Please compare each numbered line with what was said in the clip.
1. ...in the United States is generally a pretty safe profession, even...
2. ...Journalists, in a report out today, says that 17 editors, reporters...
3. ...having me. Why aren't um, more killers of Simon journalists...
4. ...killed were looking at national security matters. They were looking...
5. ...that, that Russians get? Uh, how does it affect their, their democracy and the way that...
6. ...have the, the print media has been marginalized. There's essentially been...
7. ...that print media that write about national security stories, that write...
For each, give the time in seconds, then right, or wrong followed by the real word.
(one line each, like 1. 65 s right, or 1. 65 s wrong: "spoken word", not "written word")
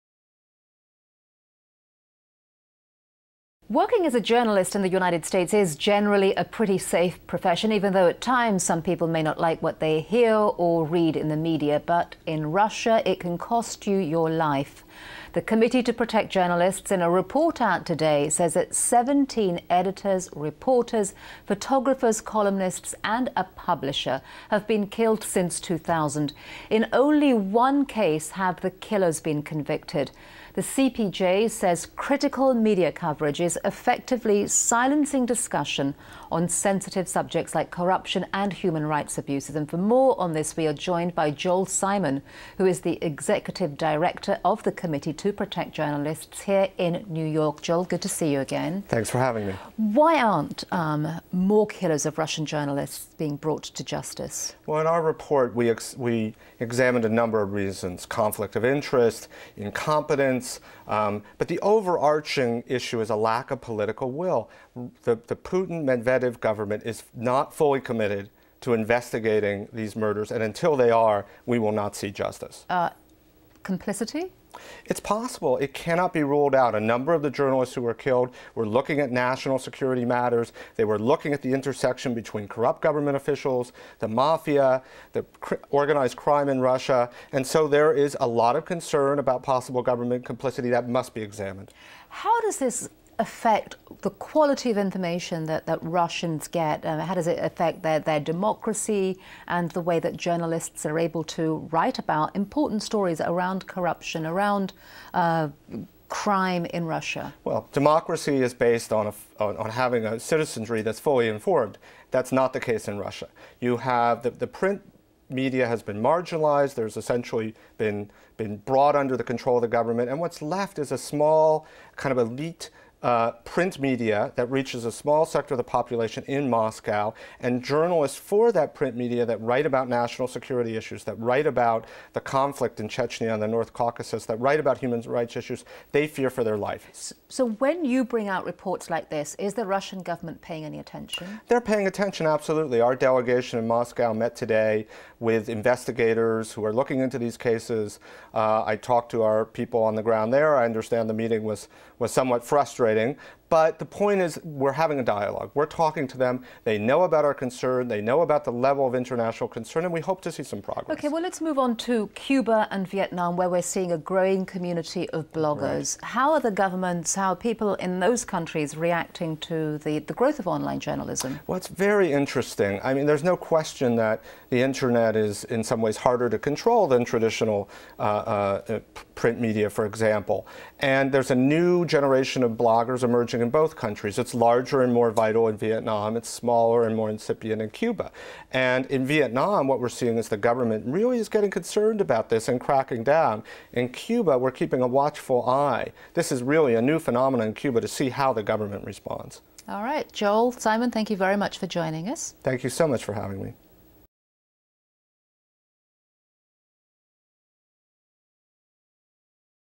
1. 4 s right
2. 16 s right
3. 49 s wrong: "Russian", not "Simon"
4. 77 s right
5. 95 s right
6. 113 s right
7. 128 s wrong: "issues", not "stories".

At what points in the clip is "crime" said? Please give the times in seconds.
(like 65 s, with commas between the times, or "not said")
86 s, 106 s.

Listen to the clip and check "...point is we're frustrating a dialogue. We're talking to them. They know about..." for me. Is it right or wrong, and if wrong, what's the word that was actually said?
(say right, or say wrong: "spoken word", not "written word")
wrong: "having", not "frustrating".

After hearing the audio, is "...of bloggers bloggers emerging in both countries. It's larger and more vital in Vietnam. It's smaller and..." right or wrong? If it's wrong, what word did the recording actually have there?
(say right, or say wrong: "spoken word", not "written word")
right.